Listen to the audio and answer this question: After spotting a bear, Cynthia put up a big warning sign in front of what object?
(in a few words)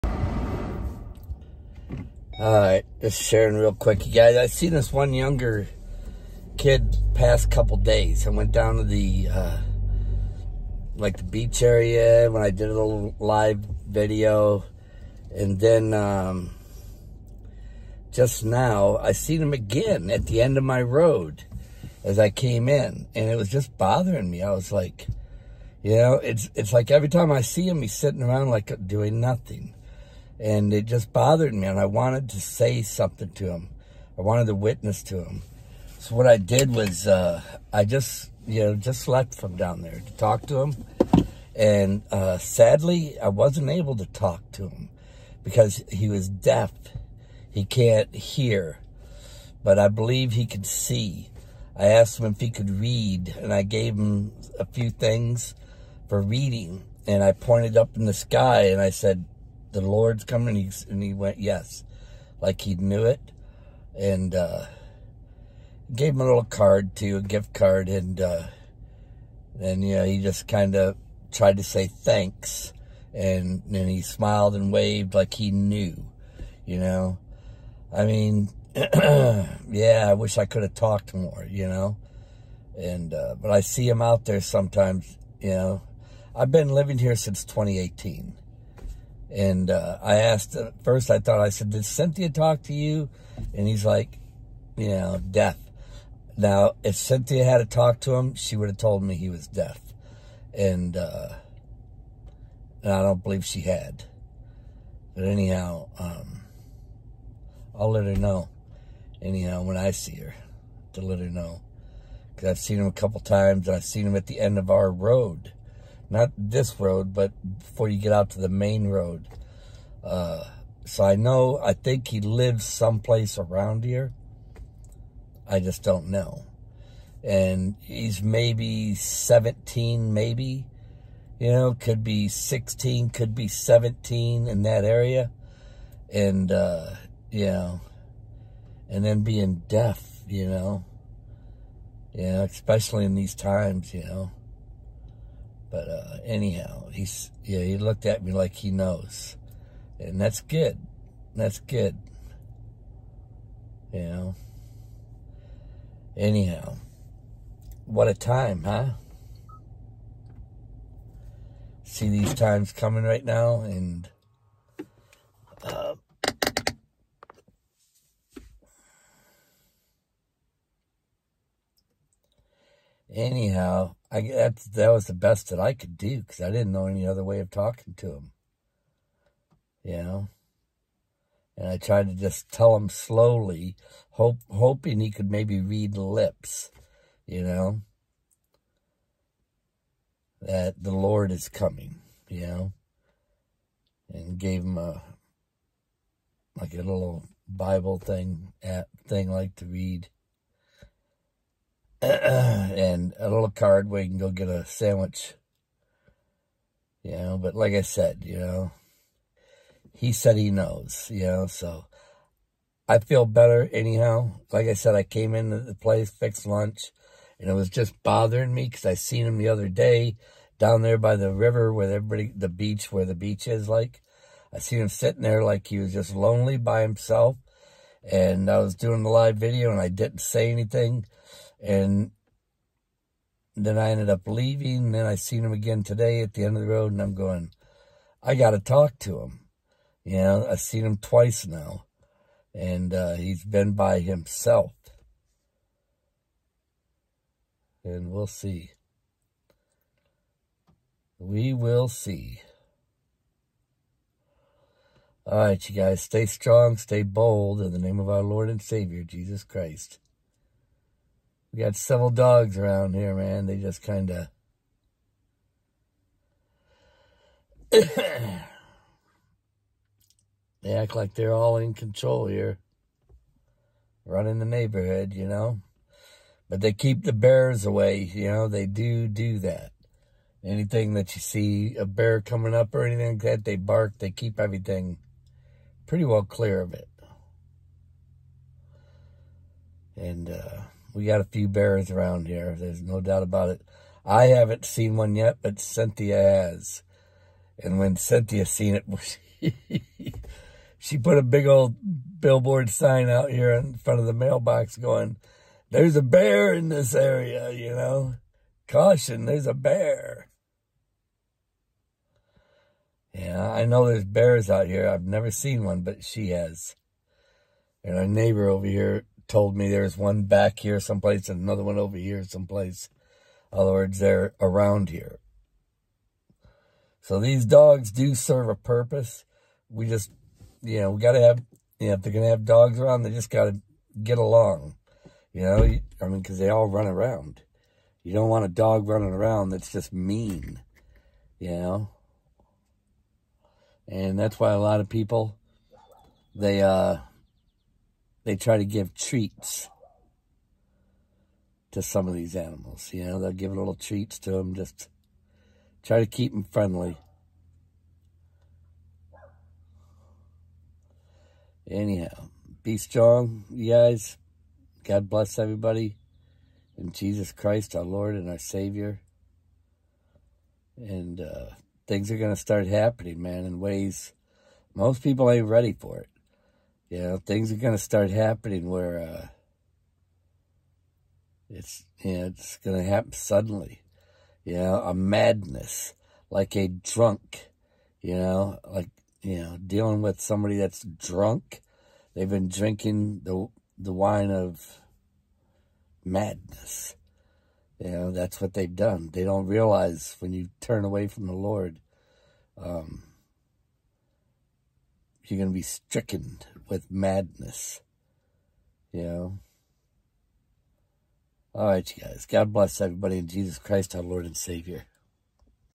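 The mailbox.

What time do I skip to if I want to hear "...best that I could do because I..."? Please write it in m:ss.
2:55.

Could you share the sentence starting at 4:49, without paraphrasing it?
And, uh, we got a few bears around here.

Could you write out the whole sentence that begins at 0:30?
And it just bothered me, and I wanted to say something to him.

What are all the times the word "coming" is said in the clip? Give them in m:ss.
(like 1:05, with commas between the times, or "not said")
1:00, 2:42, 3:11, 4:42.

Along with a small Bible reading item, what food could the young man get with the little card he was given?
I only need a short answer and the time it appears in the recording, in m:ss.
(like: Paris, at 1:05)
A sandwich, at 3:24.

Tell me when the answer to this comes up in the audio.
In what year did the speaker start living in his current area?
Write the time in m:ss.
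1:27.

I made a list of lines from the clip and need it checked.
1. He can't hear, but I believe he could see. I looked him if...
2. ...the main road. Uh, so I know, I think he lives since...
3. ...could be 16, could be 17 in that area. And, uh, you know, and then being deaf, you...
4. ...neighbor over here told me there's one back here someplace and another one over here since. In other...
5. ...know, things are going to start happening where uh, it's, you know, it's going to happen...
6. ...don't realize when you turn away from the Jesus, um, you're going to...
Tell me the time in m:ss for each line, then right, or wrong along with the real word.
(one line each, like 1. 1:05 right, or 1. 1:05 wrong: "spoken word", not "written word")
1. 0:47 wrong: "asked", not "looked"
2. 1:58 wrong: "someplace", not "since"
3. 2:11 right
4. 5:18 wrong: "someplace", not "since"
5. 6:17 right
6. 6:39 wrong: "Lord", not "Jesus".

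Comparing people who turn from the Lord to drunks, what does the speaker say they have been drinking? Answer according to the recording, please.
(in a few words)
The wine of madness.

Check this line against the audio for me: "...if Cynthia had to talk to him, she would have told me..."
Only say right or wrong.
right.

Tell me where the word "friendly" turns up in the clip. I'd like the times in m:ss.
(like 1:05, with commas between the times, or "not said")
5:56.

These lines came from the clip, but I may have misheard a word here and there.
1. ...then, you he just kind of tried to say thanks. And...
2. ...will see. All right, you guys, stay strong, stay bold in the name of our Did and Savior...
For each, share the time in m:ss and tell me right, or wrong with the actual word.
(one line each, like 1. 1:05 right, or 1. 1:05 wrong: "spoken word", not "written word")
1. 1:09 right
2. 4:11 wrong: "Lord", not "Did".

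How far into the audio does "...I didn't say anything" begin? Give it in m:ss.
3:49.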